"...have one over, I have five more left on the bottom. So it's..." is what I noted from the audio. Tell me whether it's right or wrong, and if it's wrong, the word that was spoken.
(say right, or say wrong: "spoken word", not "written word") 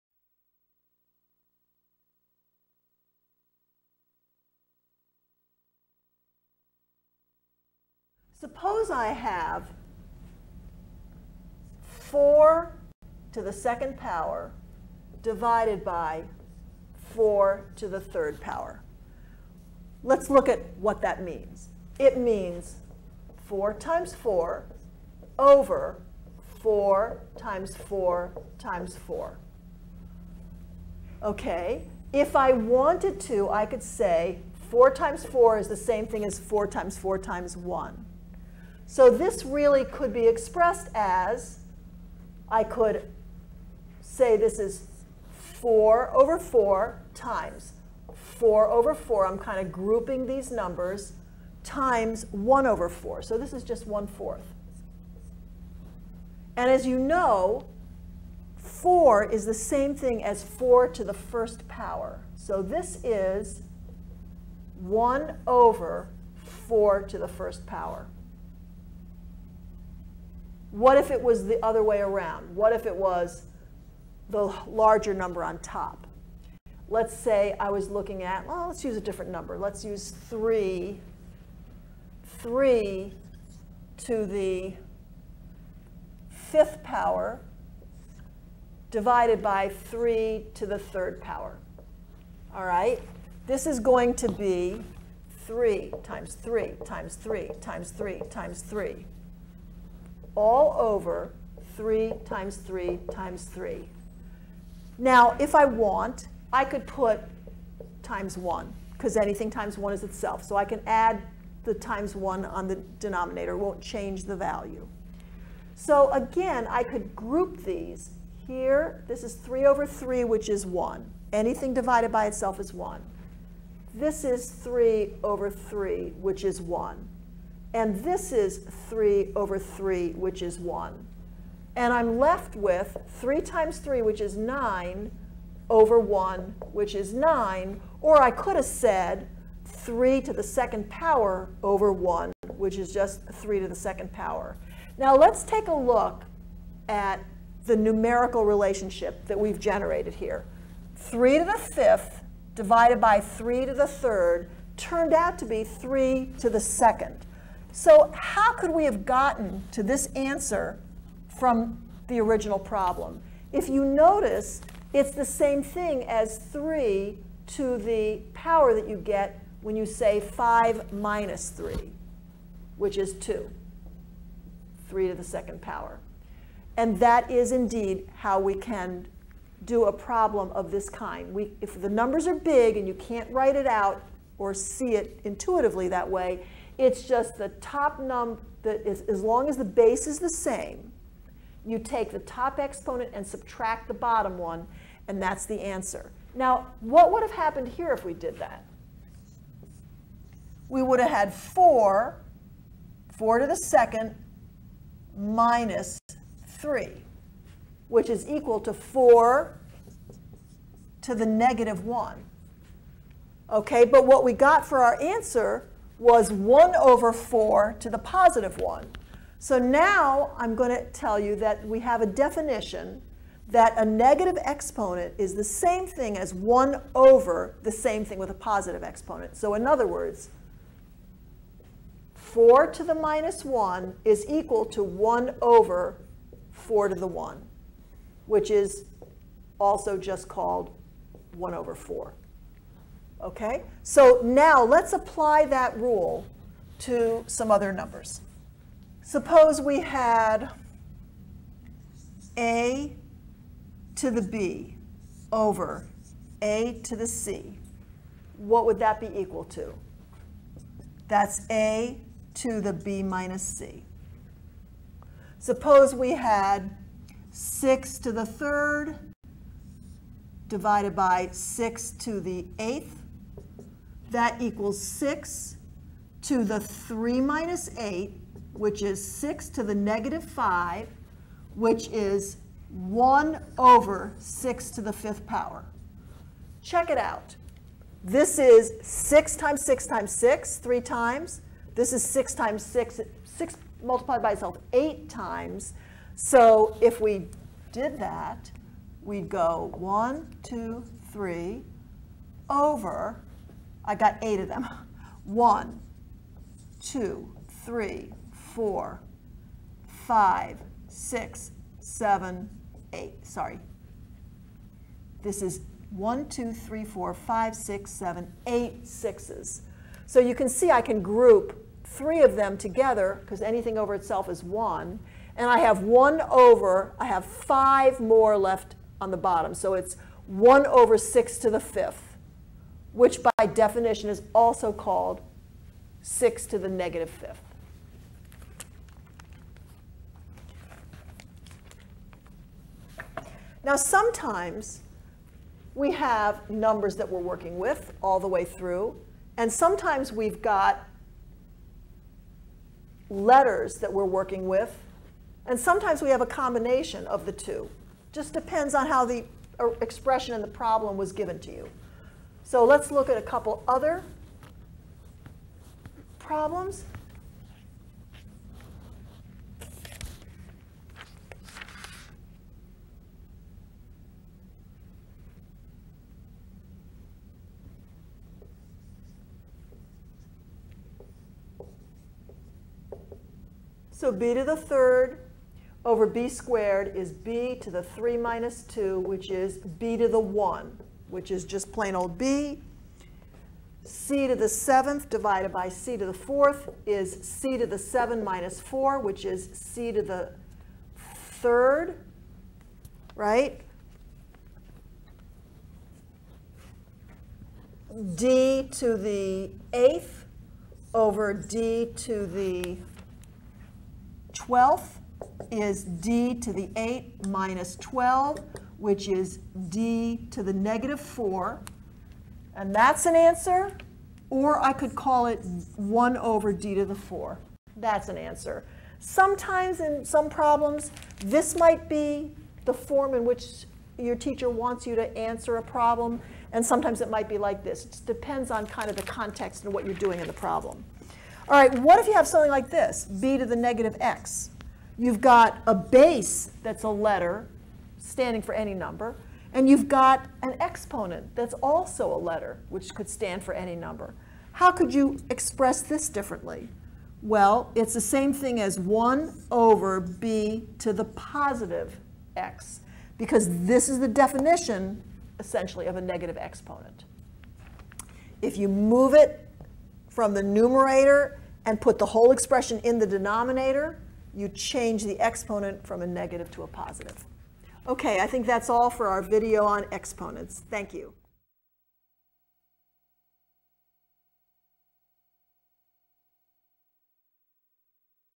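right.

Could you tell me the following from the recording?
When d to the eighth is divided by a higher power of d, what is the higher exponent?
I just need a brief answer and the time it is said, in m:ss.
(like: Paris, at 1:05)
12, at 6:54.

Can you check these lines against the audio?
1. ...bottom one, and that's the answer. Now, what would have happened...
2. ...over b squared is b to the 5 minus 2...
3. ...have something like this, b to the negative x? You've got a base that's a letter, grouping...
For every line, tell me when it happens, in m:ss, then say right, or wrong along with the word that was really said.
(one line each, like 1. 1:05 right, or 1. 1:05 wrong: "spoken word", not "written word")
1. 3:13 right
2. 6:25 wrong: "3", not "5"
3. 7:22 wrong: "standing", not "grouping".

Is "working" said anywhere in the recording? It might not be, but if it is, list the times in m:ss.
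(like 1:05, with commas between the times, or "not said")
5:47, 5:54.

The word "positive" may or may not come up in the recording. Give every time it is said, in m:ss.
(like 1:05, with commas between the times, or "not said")
3:37, 3:48, 7:41, 7:56.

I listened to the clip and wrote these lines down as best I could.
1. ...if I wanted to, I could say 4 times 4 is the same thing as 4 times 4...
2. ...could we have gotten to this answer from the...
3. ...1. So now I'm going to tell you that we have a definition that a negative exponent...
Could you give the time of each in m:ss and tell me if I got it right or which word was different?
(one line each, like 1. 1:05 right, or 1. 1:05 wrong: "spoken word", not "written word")
1. 0:32 right
2. 2:38 right
3. 3:38 right.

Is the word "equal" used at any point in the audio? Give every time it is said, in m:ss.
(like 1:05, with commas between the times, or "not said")
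3:28, 3:54, 4:19, 4:34.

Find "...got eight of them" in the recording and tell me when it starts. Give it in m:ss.
5:03.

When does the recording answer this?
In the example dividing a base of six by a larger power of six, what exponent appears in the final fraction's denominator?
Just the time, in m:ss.
4:44.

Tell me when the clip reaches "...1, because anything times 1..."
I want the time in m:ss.
1:48.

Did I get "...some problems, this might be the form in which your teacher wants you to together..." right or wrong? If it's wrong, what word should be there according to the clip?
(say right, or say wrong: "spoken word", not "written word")
wrong: "answer", not "together".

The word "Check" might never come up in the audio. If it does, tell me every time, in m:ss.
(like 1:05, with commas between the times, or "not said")
4:46.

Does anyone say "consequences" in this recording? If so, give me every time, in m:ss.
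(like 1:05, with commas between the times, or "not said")
not said.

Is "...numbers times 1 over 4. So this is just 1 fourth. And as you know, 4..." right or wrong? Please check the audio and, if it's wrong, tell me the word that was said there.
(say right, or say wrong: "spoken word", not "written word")
right.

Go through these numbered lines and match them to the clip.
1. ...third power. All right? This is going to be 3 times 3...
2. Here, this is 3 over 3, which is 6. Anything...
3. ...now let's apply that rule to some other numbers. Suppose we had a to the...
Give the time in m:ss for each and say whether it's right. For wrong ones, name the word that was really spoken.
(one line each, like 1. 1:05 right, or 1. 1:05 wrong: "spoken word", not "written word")
1. 1:30 right
2. 1:58 wrong: "1", not "6"
3. 4:04 right.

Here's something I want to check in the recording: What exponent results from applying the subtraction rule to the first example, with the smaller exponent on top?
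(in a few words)
negative 1.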